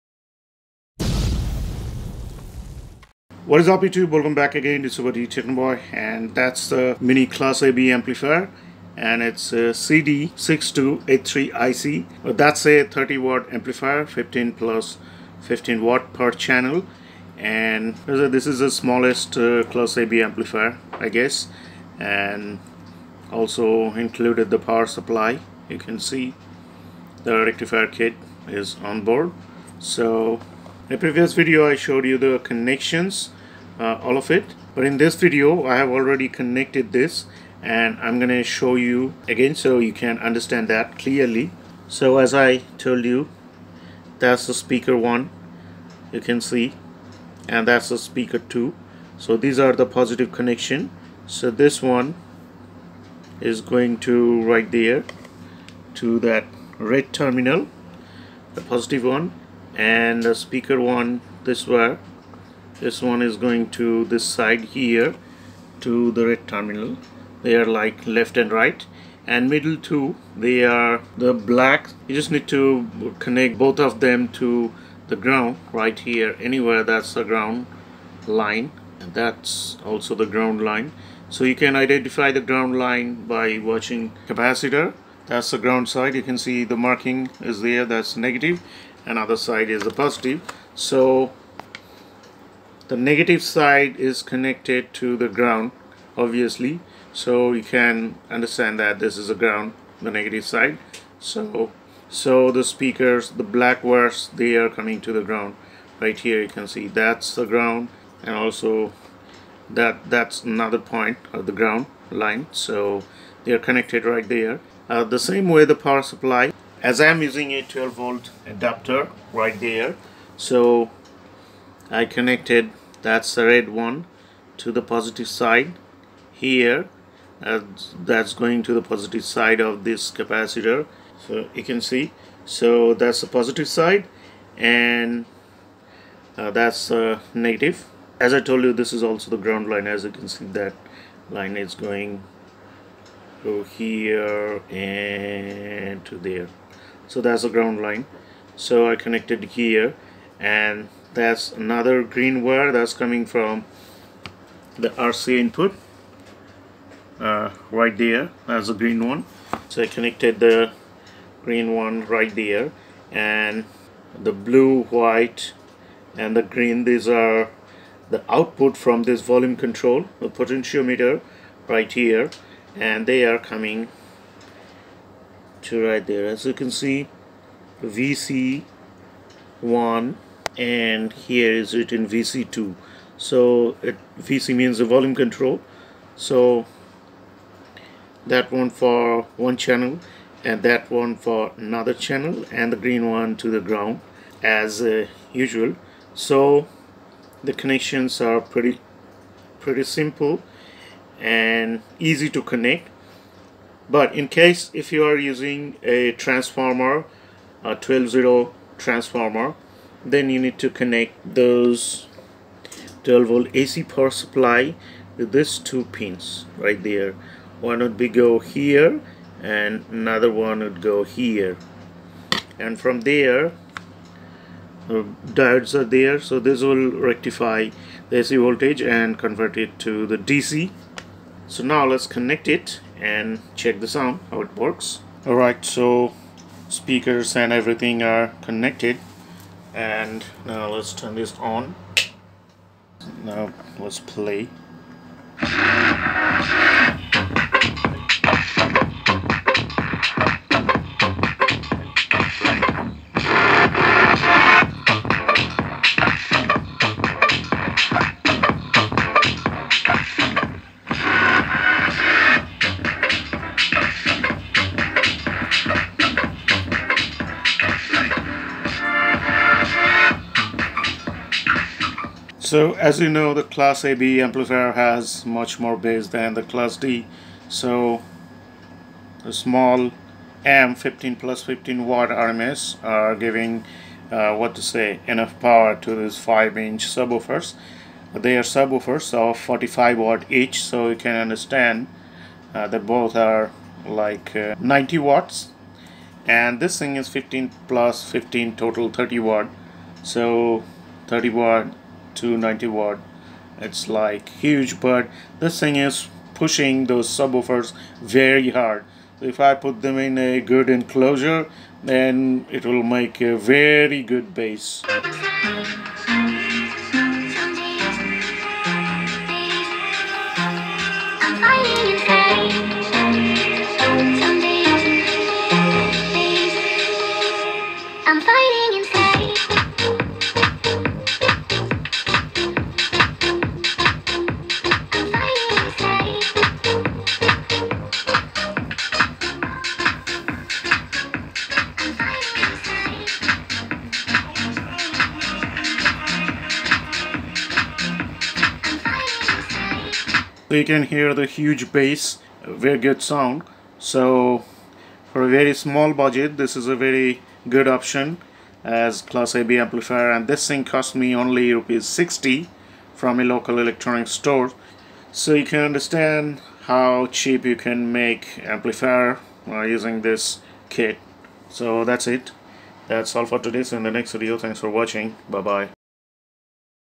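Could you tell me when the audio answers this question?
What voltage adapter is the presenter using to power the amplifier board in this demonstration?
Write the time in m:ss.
1:57.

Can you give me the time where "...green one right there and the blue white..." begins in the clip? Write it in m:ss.
2:41.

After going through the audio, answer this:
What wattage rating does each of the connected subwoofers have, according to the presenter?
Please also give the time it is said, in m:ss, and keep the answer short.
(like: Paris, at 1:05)
45 watt, at 4:49.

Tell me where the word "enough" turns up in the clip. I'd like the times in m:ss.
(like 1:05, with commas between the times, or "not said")
4:45.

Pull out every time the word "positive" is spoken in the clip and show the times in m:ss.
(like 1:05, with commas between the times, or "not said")
0:49, 0:58, 1:30, 2:04, 2:08, 2:13.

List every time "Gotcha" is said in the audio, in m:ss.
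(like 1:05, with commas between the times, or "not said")
not said.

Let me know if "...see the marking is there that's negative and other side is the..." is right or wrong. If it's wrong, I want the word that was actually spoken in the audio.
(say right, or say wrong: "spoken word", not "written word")
right.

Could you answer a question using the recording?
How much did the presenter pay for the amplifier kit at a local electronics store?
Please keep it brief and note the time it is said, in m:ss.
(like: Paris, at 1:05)
60 rupees, at 6:01.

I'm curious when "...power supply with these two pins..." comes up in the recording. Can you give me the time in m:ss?
3:33.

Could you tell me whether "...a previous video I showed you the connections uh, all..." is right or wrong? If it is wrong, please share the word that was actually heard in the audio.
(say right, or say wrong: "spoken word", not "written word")
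right.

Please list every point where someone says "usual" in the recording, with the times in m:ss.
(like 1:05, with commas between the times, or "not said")
3:15.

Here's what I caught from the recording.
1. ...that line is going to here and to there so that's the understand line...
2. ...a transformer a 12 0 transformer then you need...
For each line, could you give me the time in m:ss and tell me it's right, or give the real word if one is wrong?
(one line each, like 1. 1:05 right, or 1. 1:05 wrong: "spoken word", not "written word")
1. 2:20 wrong: "ground", not "understand"
2. 3:25 right.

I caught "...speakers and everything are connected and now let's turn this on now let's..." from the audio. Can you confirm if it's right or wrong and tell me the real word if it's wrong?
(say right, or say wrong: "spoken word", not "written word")
right.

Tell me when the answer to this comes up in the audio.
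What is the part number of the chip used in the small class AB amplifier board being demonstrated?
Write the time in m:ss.
0:09.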